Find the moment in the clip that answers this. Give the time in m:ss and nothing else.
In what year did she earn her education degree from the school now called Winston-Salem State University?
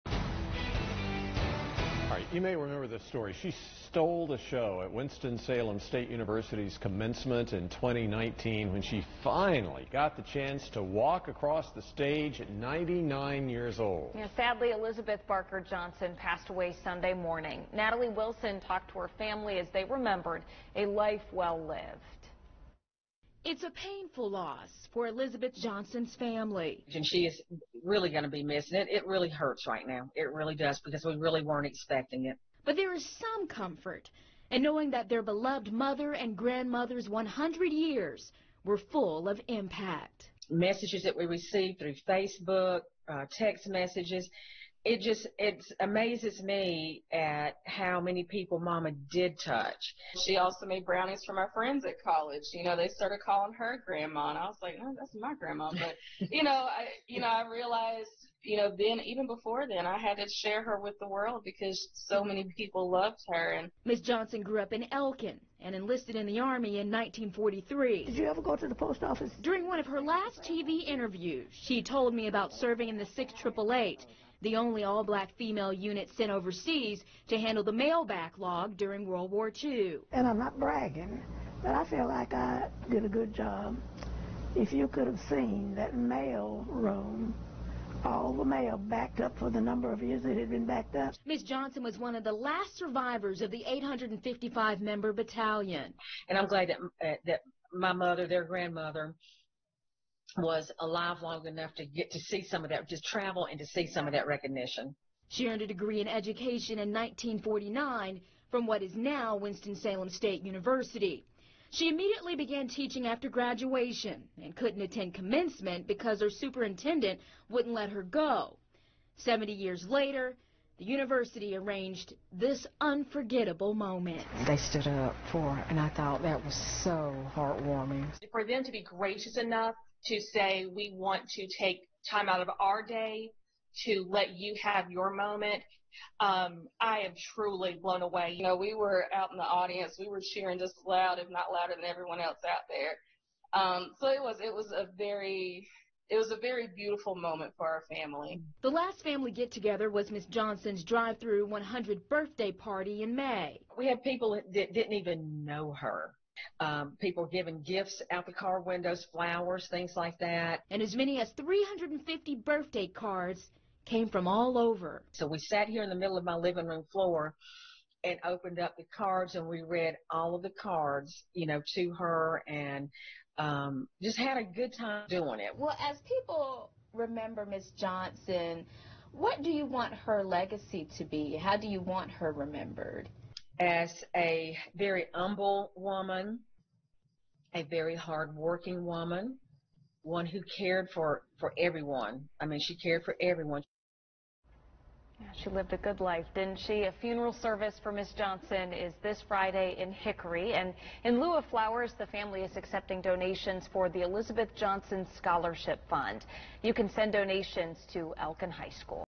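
1:46.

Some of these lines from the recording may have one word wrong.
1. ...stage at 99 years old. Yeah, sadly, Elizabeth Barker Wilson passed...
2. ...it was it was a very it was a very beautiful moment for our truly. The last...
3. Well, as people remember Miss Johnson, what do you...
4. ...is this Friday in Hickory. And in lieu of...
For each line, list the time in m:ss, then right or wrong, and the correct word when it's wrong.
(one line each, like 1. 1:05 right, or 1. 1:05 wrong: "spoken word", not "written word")
1. 0:11 wrong: "Johnson", not "Wilson"
2. 2:24 wrong: "family", not "truly"
3. 2:55 right
4. 3:18 right.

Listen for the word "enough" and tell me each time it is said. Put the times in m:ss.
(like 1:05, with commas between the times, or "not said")
1:41, 2:09.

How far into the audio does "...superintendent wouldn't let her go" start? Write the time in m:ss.
1:56.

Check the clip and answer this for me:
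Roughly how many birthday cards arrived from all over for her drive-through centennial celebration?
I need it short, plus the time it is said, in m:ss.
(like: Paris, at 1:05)
350, at 2:41.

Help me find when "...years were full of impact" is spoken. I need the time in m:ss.
0:37.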